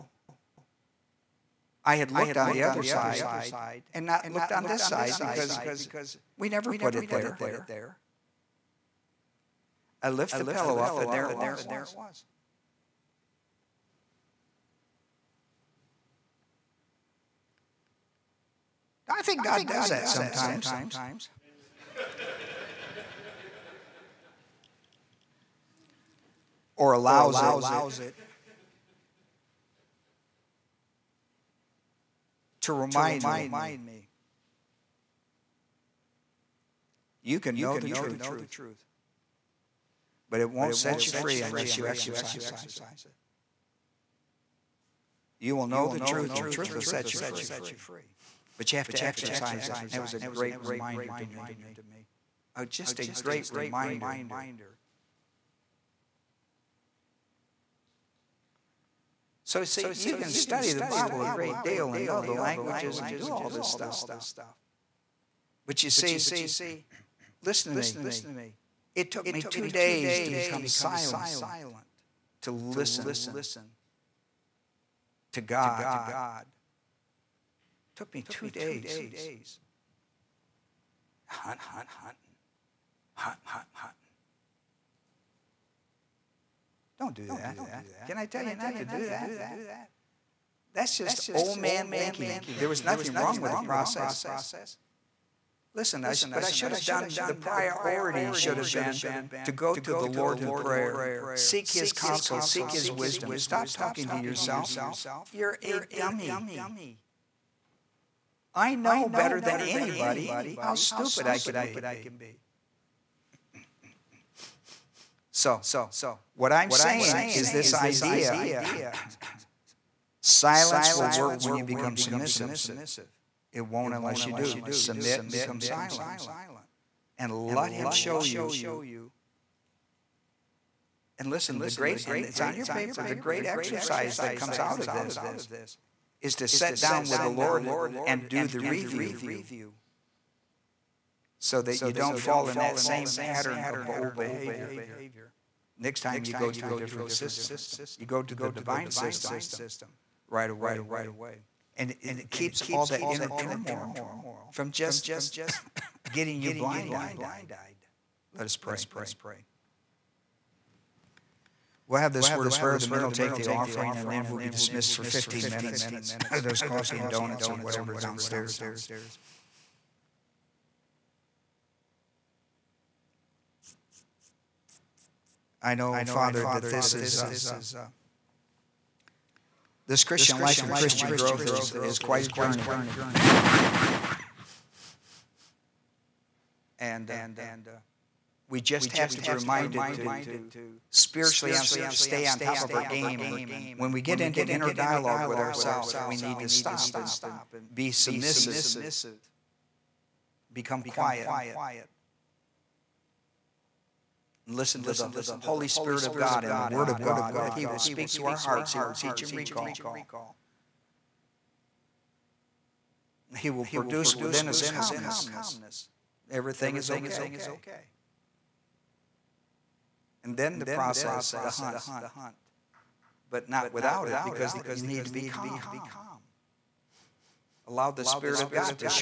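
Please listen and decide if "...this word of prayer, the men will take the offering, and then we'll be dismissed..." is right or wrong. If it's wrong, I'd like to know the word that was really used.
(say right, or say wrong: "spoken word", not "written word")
right.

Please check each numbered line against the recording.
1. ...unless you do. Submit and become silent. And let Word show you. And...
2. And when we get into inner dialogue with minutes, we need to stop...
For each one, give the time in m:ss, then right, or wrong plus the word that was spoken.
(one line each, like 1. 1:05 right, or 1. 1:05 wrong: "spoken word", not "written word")
1. 2:03 wrong: "Him", not "Word"
2. 3:13 wrong: "ourselves", not "minutes".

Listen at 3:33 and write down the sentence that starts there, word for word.
He will produce within us a calmness.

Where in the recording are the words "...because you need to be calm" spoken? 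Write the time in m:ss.
3:44.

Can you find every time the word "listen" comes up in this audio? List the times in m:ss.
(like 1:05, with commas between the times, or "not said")
1:07, 1:12, 1:35, 2:11, 3:24.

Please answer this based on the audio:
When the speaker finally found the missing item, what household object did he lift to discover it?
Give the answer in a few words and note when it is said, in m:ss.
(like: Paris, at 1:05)
pillow, at 0:10.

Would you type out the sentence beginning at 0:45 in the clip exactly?
You will know the truth, and the truth will set you free.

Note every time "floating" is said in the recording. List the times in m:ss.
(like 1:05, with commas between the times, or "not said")
not said.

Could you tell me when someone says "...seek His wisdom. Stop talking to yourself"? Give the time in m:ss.
1:42.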